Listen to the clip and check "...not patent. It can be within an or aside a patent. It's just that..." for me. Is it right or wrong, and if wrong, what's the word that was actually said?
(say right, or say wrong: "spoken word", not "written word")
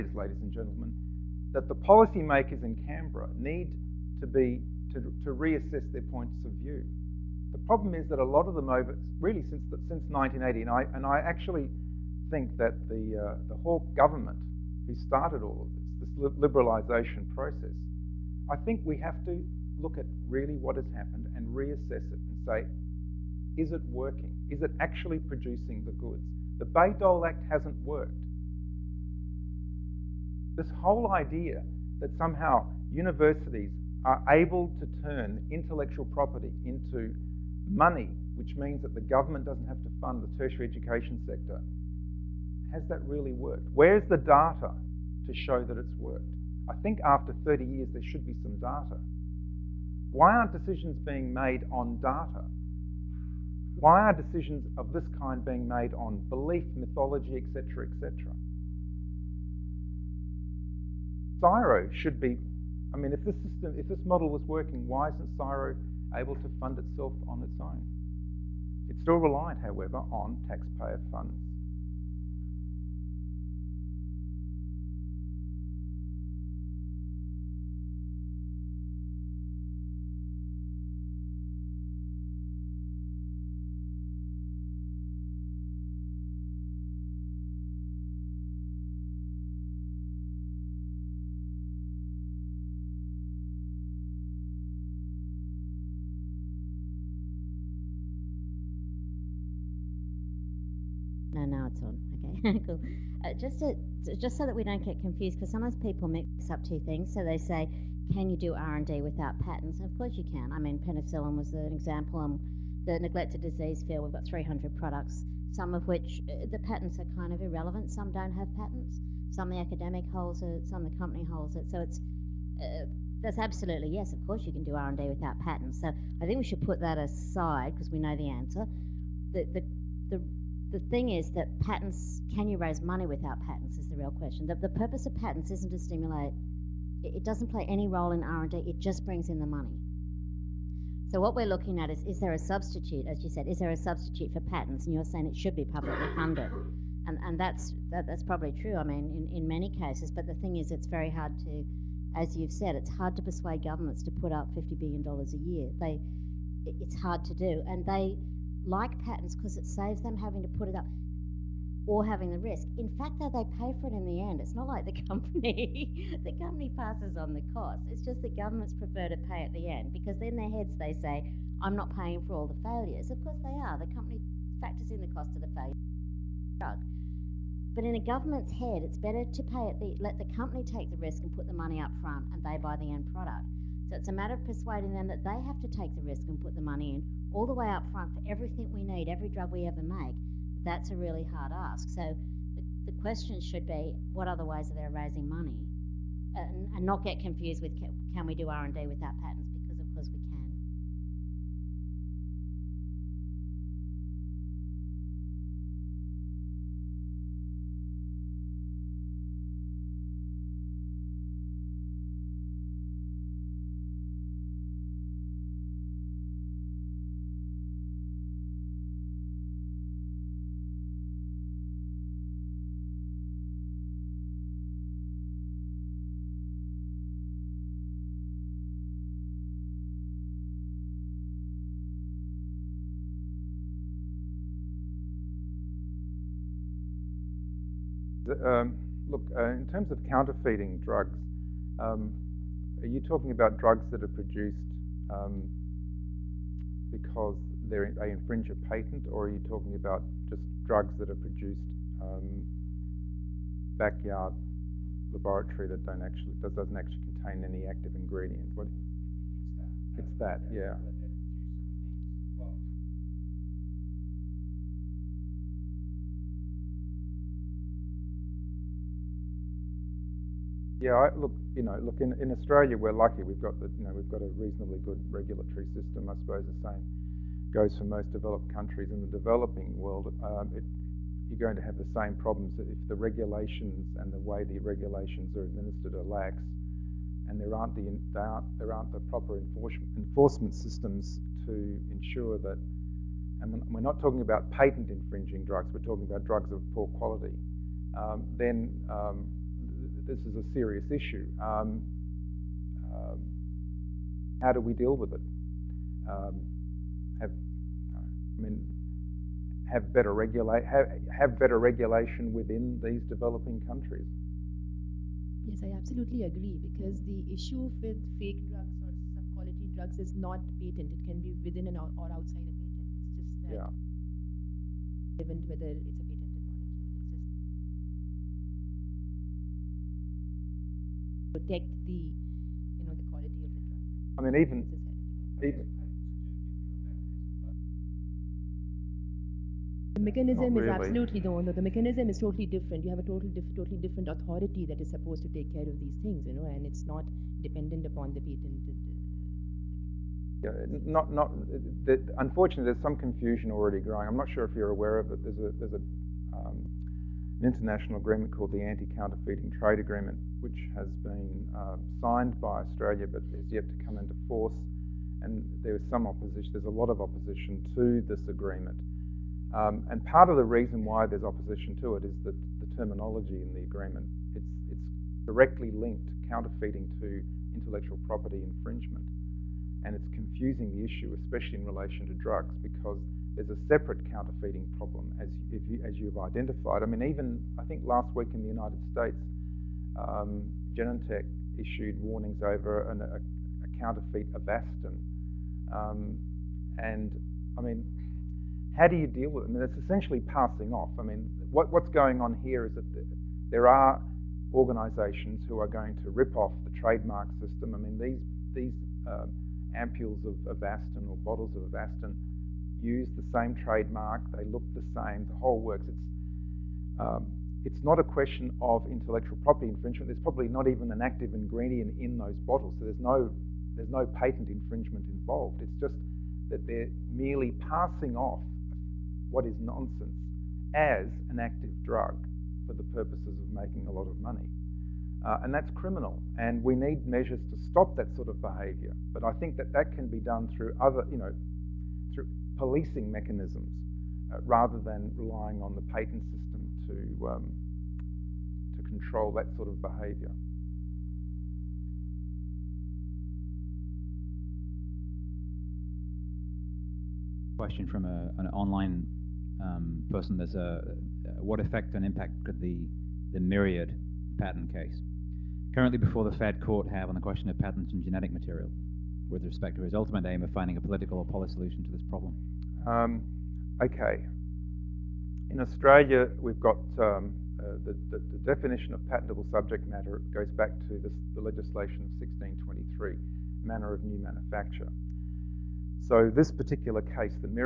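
wrong: "outside", not "aside".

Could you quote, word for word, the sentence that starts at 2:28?
I mean, in, in many cases.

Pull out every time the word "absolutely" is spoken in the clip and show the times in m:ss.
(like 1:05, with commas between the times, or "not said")
2:03, 5:15, 5:40.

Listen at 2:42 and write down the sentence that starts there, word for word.
In fact, though, they pay for it in the end.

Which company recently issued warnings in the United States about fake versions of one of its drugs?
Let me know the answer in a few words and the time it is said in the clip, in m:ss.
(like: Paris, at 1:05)
Genentech, at 6:30.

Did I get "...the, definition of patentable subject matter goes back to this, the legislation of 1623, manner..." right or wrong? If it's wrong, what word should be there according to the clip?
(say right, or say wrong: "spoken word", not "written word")
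right.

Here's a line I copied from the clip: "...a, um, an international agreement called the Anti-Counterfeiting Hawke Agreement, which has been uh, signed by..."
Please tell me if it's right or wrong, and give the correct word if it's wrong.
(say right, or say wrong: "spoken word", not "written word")
wrong: "Trade", not "Hawke".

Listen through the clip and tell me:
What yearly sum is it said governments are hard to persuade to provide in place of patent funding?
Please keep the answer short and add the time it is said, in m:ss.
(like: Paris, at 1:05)
50 billion dollars, at 2:34.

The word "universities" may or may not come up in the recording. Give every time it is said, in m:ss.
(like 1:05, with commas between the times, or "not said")
0:32.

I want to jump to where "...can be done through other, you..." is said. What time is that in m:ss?
7:19.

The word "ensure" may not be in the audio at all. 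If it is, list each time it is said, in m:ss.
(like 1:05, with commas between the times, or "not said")
4:51.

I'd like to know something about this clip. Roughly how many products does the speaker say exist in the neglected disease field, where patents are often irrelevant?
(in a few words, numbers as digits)
300.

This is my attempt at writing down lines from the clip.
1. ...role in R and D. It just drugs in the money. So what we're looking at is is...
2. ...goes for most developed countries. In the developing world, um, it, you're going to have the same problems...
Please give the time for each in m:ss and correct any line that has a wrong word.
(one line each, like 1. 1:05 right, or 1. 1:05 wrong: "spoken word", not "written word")
1. 2:17 wrong: "brings", not "drugs"
2. 4:37 right.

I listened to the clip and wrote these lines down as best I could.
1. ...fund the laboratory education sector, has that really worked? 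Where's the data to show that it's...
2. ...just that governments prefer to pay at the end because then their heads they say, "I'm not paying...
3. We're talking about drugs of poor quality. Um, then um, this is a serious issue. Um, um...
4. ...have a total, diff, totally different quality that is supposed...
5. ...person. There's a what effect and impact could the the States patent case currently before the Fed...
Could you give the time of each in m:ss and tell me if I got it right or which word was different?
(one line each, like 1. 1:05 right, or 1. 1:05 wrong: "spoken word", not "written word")
1. 0:39 wrong: "tertiary", not "laboratory"
2. 2:48 right
3. 4:55 right
4. 5:42 wrong: "authority", not "quality"
5. 7:40 wrong: "Myriad", not "States".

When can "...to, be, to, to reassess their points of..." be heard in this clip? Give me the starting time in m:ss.
0:04.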